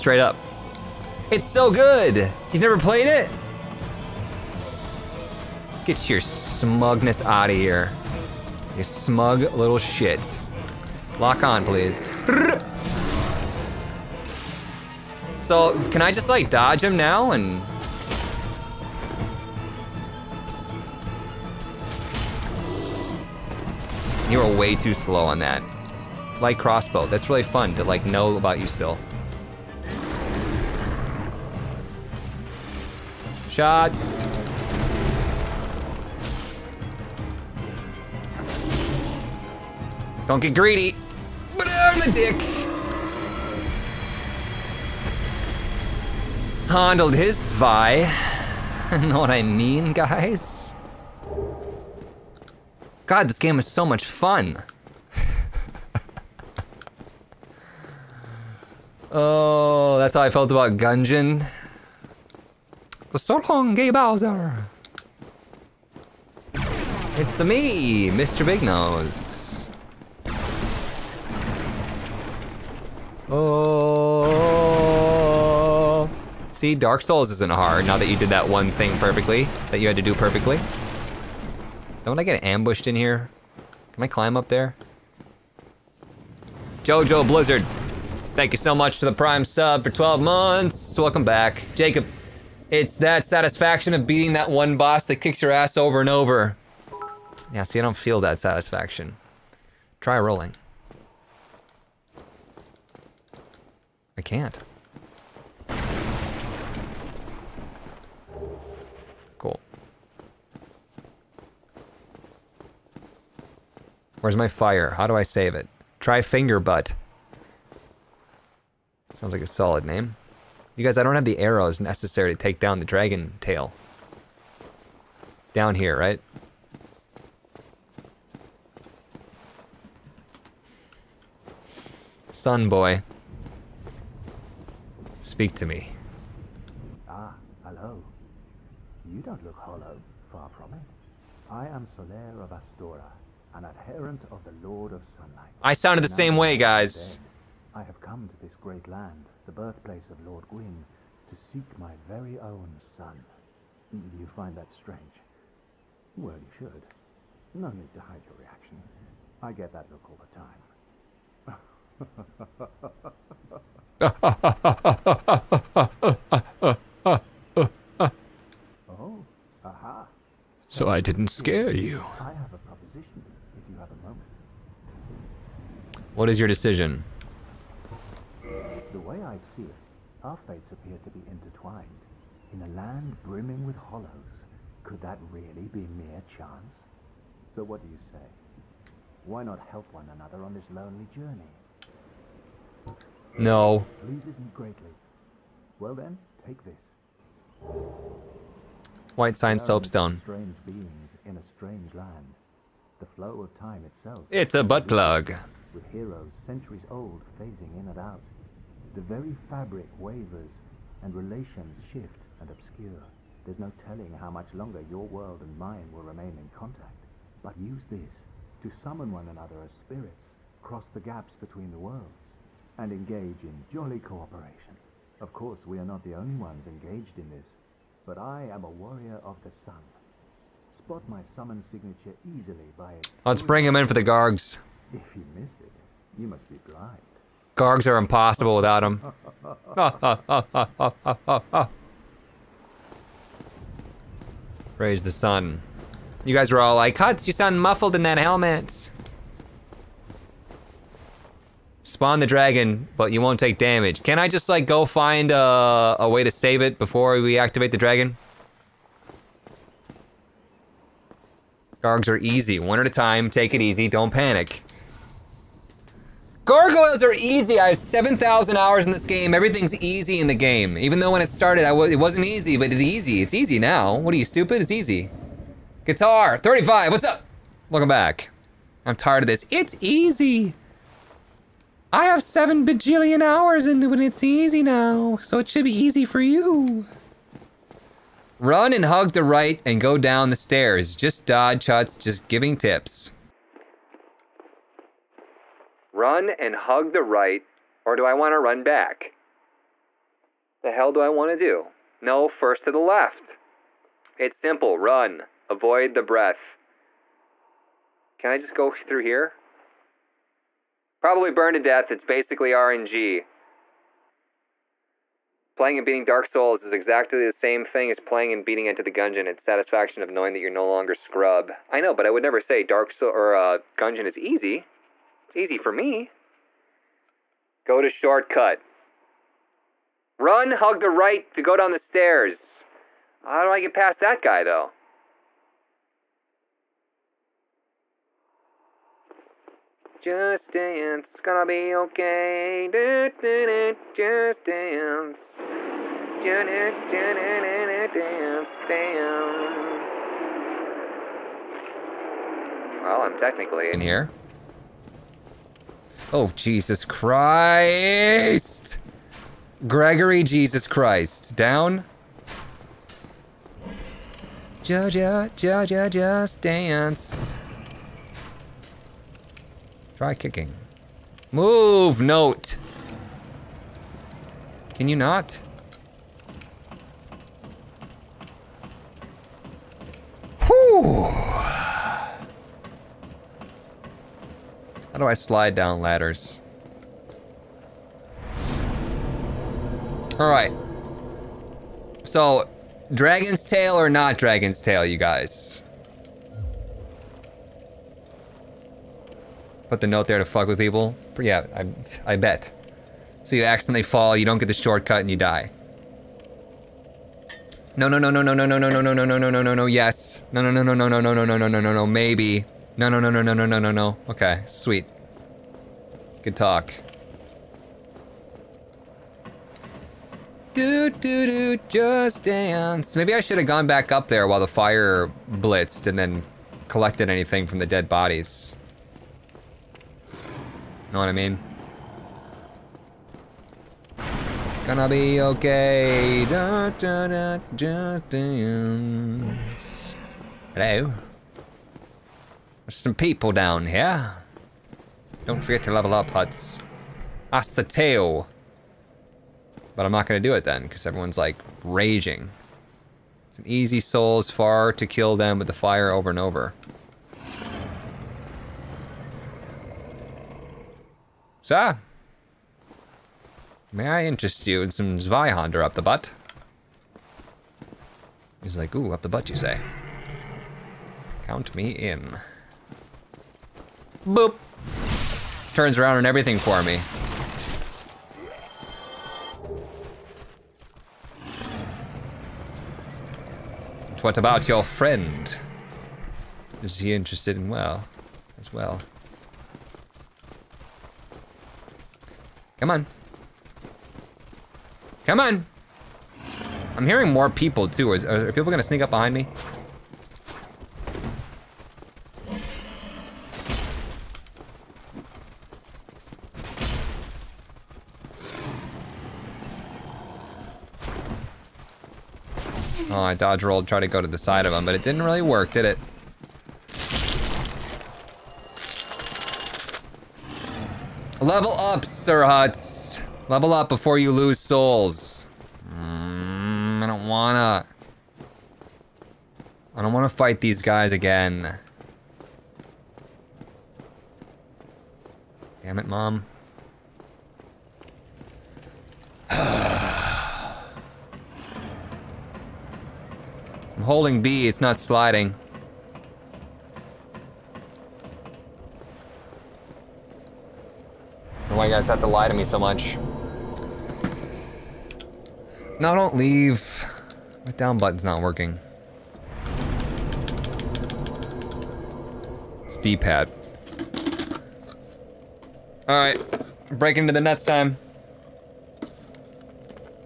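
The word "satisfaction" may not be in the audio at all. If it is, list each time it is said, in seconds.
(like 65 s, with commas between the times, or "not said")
93 s, 98 s, 319 s.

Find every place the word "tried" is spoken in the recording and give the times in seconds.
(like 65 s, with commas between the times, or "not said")
513 s.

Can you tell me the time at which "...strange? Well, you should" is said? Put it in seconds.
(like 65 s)
154 s.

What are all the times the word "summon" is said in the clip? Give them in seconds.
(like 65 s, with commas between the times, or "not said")
218 s, 231 s.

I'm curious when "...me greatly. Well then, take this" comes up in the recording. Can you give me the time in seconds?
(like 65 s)
194 s.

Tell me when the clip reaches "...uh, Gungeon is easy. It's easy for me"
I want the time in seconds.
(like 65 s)
323 s.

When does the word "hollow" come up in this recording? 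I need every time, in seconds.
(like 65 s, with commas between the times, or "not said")
139 s, 183 s.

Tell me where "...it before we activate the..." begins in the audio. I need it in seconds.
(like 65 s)
256 s.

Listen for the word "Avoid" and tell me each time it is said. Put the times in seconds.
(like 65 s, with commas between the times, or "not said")
305 s.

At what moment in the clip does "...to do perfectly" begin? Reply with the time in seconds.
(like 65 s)
79 s.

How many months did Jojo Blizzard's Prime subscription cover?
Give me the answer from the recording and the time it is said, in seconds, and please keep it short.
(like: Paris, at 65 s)
12, at 89 s.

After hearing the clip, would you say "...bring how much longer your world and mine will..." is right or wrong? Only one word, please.
wrong.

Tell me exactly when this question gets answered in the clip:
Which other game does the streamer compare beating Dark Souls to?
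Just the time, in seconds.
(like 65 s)
318 s.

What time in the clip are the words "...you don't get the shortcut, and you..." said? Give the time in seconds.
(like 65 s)
404 s.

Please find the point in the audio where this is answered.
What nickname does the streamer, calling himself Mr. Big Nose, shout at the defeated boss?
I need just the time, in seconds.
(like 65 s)
63 s.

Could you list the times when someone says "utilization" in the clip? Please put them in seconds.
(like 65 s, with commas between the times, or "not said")
not said.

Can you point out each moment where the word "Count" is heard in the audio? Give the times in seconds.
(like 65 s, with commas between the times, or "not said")
471 s.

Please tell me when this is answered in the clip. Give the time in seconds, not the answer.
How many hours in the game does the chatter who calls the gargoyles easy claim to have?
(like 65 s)
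267 s.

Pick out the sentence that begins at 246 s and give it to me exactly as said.
You guys were all like, Hutts, you sound muffled in that helmet.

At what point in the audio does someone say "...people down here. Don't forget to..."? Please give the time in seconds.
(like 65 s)
442 s.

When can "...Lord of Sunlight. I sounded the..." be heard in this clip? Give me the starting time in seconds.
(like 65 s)
144 s.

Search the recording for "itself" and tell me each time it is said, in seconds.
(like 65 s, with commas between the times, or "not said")
203 s.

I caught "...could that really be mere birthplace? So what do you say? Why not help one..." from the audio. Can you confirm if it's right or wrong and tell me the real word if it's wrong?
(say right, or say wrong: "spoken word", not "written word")
wrong: "chance", not "birthplace".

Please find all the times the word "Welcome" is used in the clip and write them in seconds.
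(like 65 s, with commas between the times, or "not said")
90 s, 277 s.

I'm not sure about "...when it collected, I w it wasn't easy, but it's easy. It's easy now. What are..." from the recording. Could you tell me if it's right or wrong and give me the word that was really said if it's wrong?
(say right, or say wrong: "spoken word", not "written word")
wrong: "started", not "collected".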